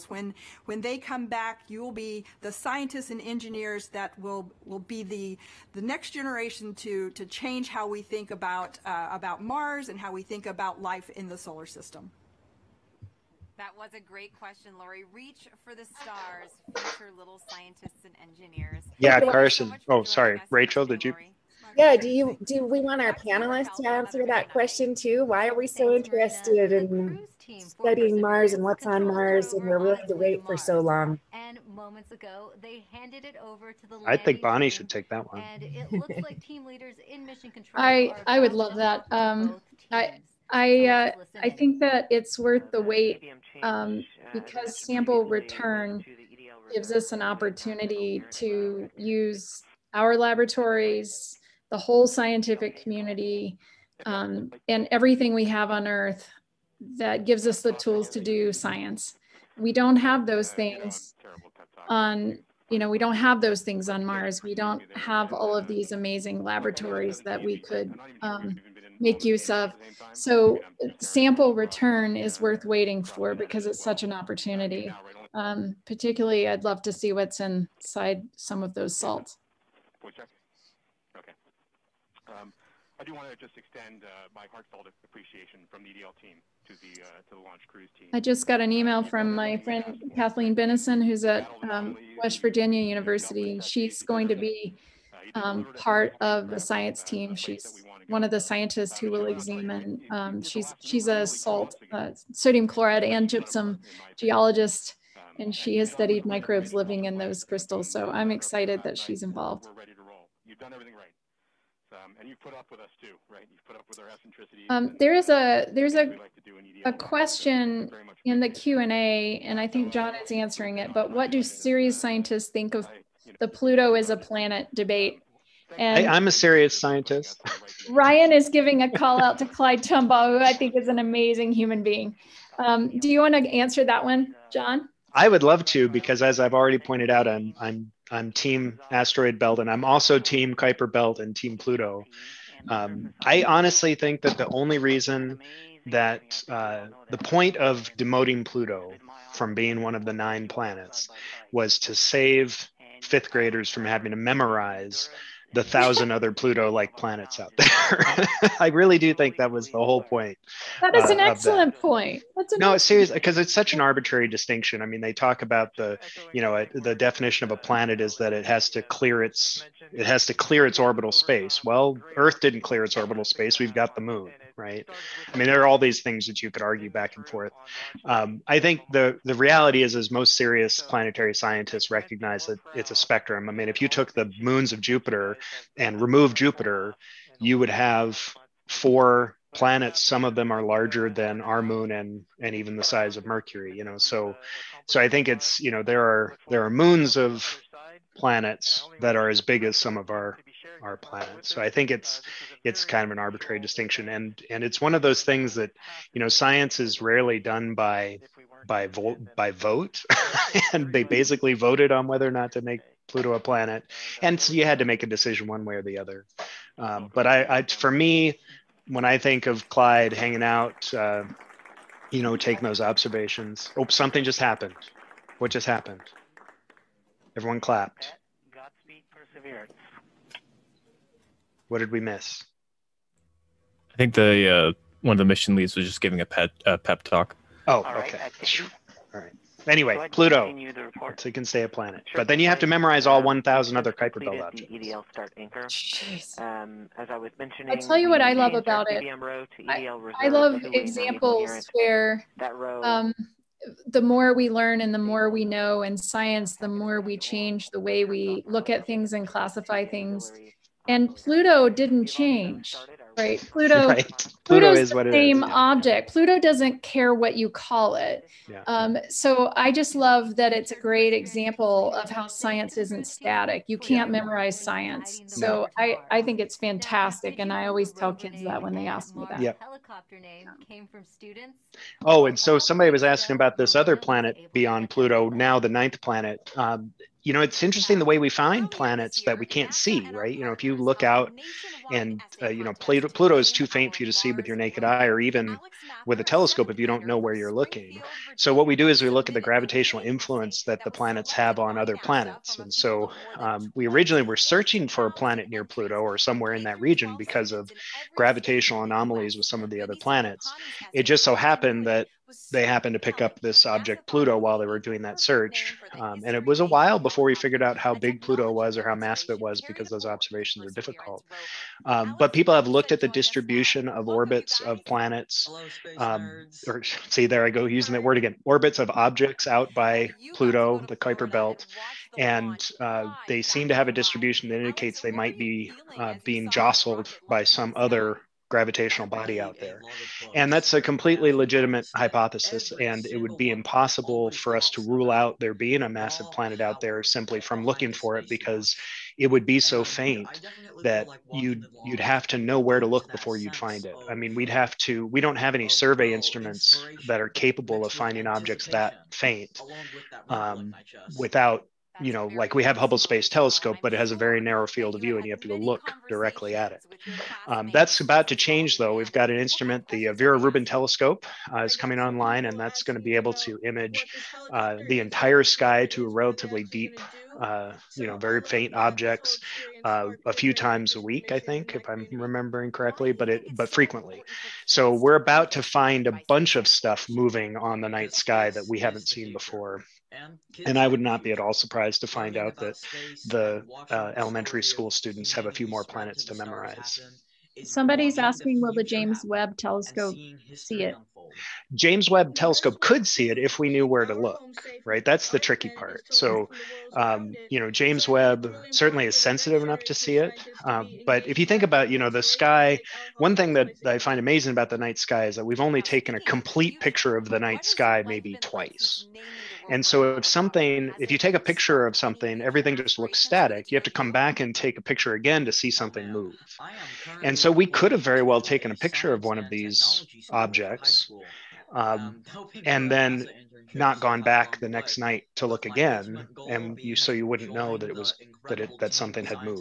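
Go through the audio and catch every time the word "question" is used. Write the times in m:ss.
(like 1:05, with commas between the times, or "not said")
0:14, 0:24, 1:56.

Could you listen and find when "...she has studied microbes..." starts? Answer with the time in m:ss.
1:45.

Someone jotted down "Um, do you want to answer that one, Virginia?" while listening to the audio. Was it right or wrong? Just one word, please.
wrong.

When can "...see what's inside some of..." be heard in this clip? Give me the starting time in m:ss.
1:16.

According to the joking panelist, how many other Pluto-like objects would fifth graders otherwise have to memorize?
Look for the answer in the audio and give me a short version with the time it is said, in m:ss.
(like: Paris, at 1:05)
1,000, at 2:35.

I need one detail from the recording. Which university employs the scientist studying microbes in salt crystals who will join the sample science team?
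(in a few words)
West Virginia University.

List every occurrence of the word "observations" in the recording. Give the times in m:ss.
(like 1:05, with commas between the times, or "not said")
3:42, 5:20.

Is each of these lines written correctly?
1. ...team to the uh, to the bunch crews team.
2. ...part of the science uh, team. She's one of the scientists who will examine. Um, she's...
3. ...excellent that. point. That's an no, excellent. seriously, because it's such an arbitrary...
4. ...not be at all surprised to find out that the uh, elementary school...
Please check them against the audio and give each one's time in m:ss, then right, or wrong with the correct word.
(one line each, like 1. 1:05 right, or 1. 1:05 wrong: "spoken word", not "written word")
1. 1:26 wrong: "launch", not "bunch"
2. 1:35 right
3. 2:41 right
4. 6:31 right.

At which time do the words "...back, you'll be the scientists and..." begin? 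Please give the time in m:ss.
0:01.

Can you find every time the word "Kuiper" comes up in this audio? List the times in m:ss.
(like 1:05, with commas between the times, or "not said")
2:20, 4:03, 5:30.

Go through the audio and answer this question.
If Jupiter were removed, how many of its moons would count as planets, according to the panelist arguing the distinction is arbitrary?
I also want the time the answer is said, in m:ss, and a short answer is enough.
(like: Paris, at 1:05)
4, at 3:08.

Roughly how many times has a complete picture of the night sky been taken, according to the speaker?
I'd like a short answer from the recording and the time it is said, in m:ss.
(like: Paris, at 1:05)
2, at 6:58.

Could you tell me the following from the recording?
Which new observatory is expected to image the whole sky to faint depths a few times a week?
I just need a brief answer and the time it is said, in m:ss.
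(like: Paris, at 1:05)
Vera Rubin Telescope, at 6:10.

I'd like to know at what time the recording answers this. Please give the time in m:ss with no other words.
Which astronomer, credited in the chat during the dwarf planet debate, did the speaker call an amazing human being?
2:09.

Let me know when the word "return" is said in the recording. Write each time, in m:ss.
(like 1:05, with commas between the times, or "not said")
0:45, 1:11.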